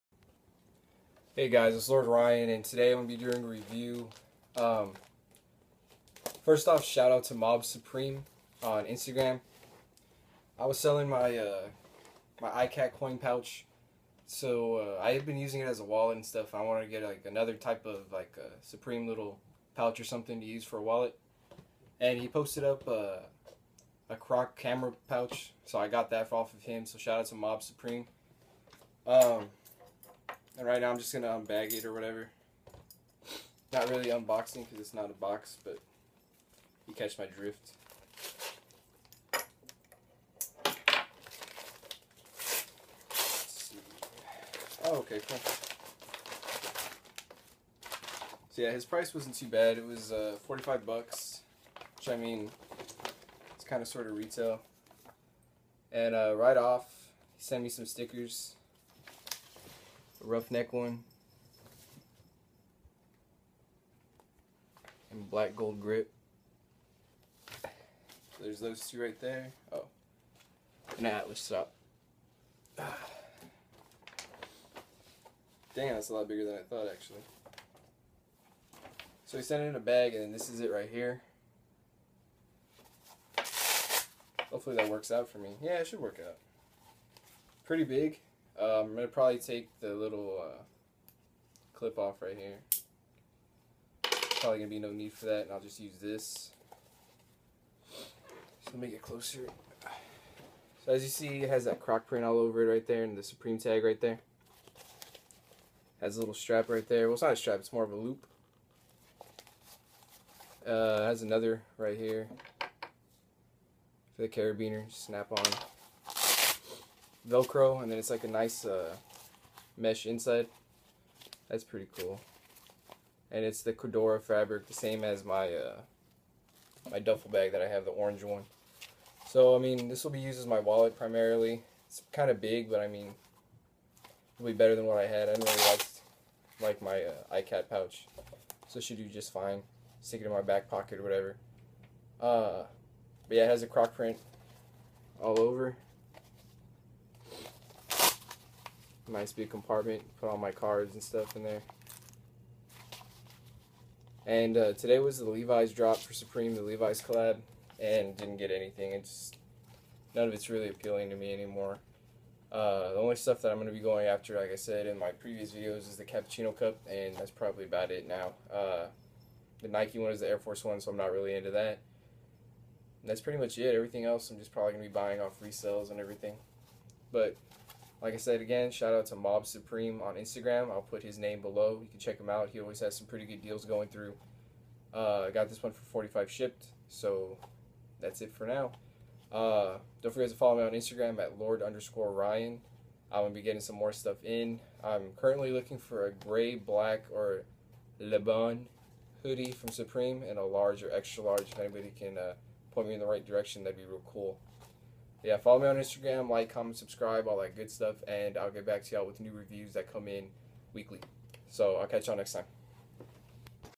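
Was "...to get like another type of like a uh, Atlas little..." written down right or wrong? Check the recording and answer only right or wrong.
wrong.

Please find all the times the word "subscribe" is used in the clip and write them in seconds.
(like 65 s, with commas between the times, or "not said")
206 s.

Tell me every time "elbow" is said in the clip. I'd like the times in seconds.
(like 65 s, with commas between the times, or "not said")
not said.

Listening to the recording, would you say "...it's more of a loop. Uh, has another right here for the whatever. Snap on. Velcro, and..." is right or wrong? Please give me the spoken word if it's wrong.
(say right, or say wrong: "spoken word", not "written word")
wrong: "carabiner", not "whatever".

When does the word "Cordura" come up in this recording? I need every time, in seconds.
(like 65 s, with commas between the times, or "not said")
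123 s.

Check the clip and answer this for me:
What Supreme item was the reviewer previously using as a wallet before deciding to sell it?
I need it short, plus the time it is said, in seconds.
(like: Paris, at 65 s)
iCat coin pouch, at 12 s.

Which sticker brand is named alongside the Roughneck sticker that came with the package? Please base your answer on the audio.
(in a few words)
Black gold grip.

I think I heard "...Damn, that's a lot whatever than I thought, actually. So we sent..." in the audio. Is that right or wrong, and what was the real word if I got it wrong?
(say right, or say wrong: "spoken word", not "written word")
wrong: "bigger", not "whatever".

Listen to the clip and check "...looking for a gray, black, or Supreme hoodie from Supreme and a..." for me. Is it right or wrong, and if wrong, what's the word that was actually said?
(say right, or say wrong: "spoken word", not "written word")
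wrong: "Lebon", not "Supreme".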